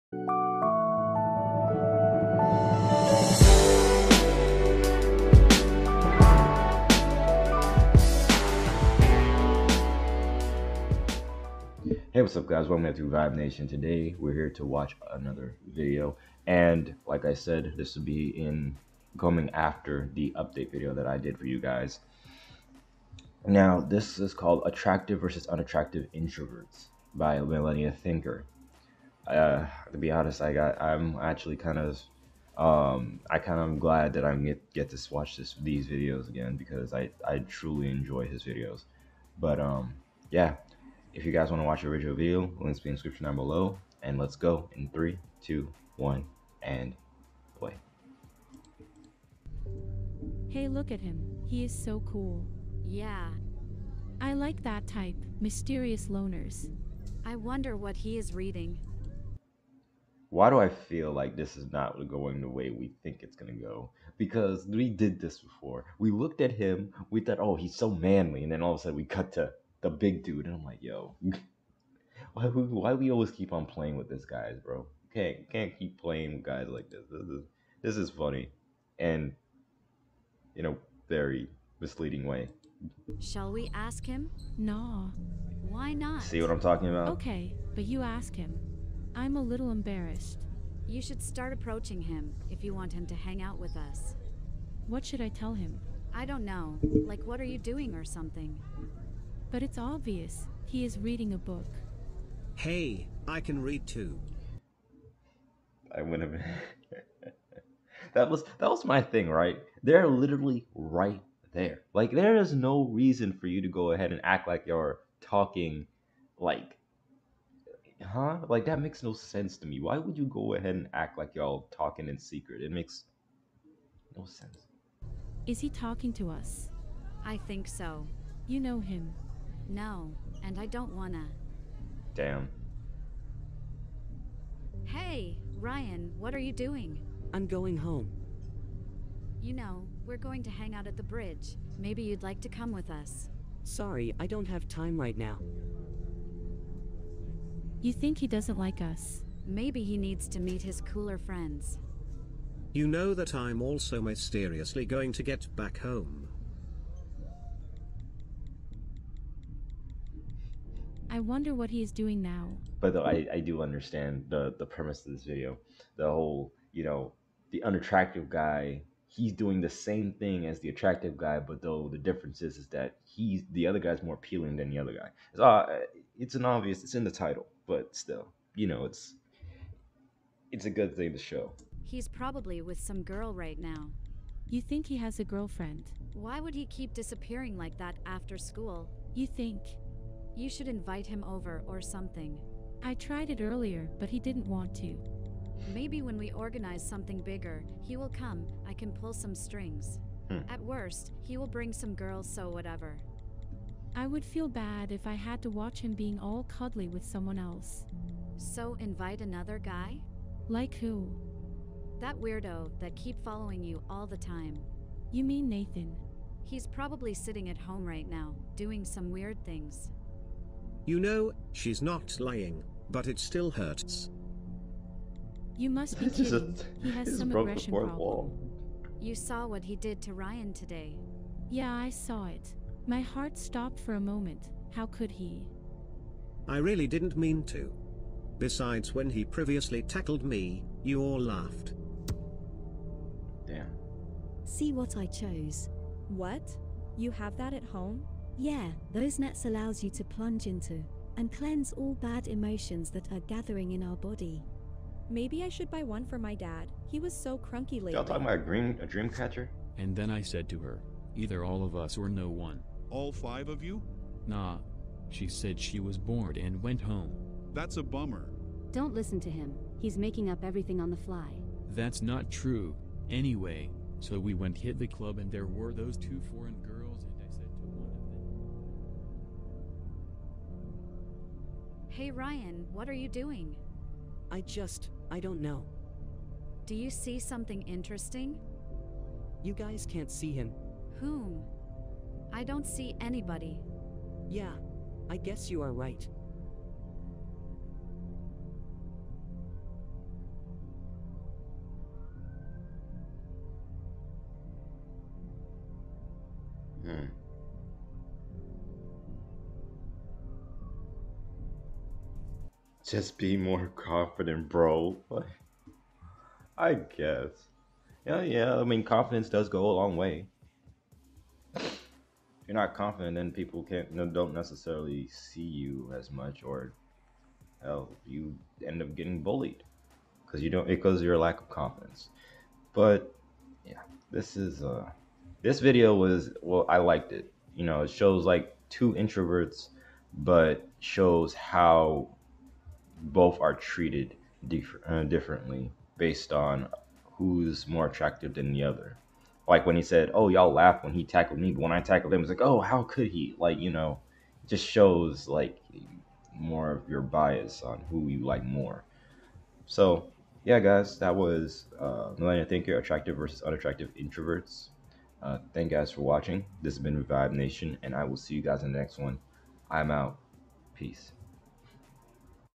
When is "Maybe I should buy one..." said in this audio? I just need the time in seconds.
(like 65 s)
255 s.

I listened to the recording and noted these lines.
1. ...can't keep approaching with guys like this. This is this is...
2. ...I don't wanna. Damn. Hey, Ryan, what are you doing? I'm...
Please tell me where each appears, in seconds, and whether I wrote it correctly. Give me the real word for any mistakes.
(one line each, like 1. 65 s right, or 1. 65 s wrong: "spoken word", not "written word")
1. 75 s wrong: "playing", not "approaching"
2. 130 s right.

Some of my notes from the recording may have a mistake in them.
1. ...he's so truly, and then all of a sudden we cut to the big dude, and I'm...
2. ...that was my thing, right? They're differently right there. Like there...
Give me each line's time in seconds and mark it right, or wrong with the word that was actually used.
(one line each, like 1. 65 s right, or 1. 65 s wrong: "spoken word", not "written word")
1. 67 s wrong: "manly", not "truly"
2. 108 s wrong: "literally", not "differently".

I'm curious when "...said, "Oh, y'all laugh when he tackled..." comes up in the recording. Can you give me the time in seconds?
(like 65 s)
349 s.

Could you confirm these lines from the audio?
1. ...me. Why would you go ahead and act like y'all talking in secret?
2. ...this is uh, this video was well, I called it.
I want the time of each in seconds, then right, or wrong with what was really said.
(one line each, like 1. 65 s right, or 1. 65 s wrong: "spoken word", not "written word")
1. 119 s right
2. 334 s wrong: "liked", not "called".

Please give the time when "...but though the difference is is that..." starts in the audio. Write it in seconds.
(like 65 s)
171 s.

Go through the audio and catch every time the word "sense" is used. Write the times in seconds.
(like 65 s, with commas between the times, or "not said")
119 s, 124 s.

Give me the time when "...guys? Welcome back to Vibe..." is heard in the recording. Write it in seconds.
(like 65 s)
12 s.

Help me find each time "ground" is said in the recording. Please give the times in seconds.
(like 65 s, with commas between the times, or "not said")
not said.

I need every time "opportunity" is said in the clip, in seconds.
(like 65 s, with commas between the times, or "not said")
not said.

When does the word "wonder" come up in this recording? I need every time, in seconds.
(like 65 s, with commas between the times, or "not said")
57 s, 161 s.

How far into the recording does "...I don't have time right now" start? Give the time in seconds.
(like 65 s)
144 s.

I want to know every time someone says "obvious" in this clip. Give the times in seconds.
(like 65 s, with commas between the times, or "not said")
99 s, 176 s.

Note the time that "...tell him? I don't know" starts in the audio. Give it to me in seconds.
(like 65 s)
95 s.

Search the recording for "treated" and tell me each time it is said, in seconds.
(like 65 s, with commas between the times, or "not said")
343 s.